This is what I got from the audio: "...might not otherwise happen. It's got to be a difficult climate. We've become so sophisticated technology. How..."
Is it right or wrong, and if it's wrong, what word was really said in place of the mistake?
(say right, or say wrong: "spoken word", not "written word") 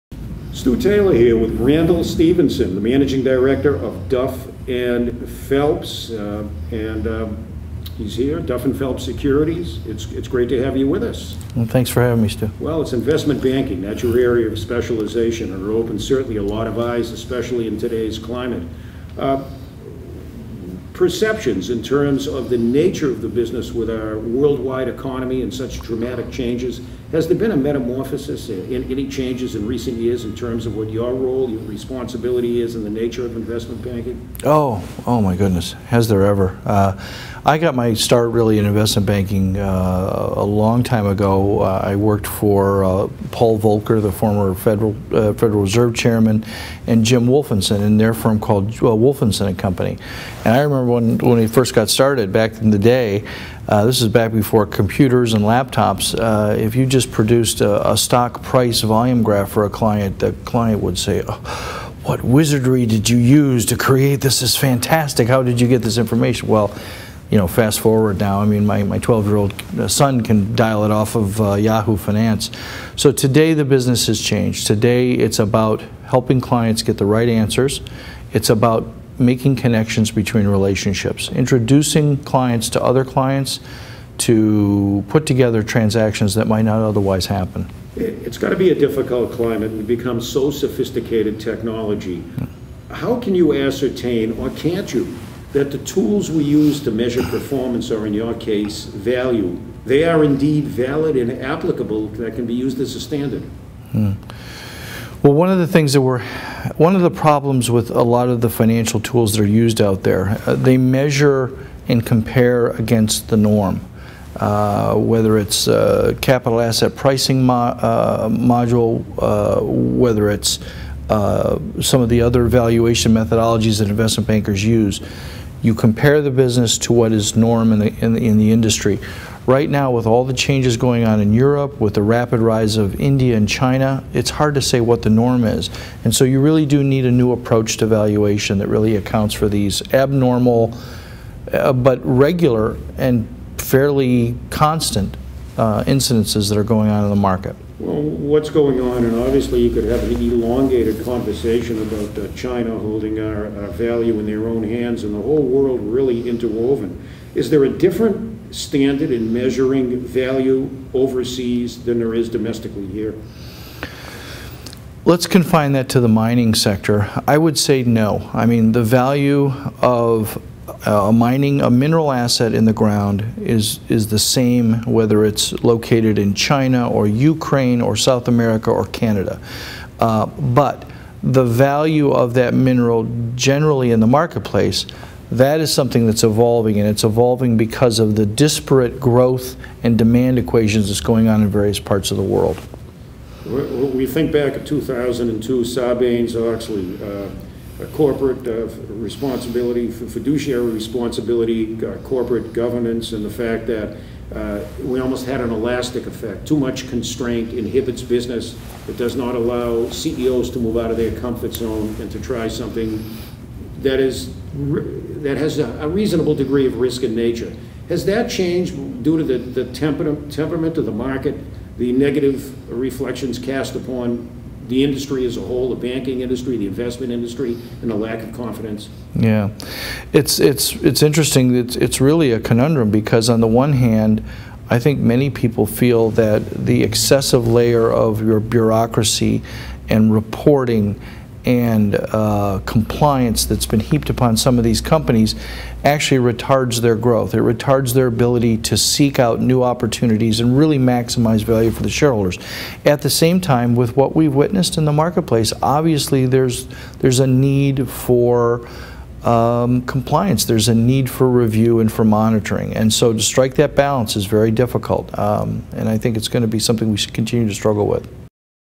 right.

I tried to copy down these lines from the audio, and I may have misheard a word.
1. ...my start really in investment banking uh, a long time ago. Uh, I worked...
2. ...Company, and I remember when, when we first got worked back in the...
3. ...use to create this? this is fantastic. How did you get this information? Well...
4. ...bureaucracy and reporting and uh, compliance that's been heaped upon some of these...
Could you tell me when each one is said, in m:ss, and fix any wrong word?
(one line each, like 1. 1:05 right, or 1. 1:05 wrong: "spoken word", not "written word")
1. 0:37 right
2. 0:49 wrong: "started", not "worked"
3. 1:03 right
4. 3:58 right.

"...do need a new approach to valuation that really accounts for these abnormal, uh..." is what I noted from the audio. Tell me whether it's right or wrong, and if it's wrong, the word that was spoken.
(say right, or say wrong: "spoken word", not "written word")
right.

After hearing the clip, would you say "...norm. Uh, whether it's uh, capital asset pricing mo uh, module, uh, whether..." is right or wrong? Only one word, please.
right.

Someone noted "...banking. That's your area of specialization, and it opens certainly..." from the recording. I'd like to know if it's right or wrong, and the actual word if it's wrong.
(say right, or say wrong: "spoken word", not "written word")
right.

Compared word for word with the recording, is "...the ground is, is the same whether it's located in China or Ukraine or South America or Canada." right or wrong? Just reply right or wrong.
right.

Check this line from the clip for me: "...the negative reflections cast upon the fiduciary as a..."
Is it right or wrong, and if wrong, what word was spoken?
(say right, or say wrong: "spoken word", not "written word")
wrong: "industry", not "fiduciary".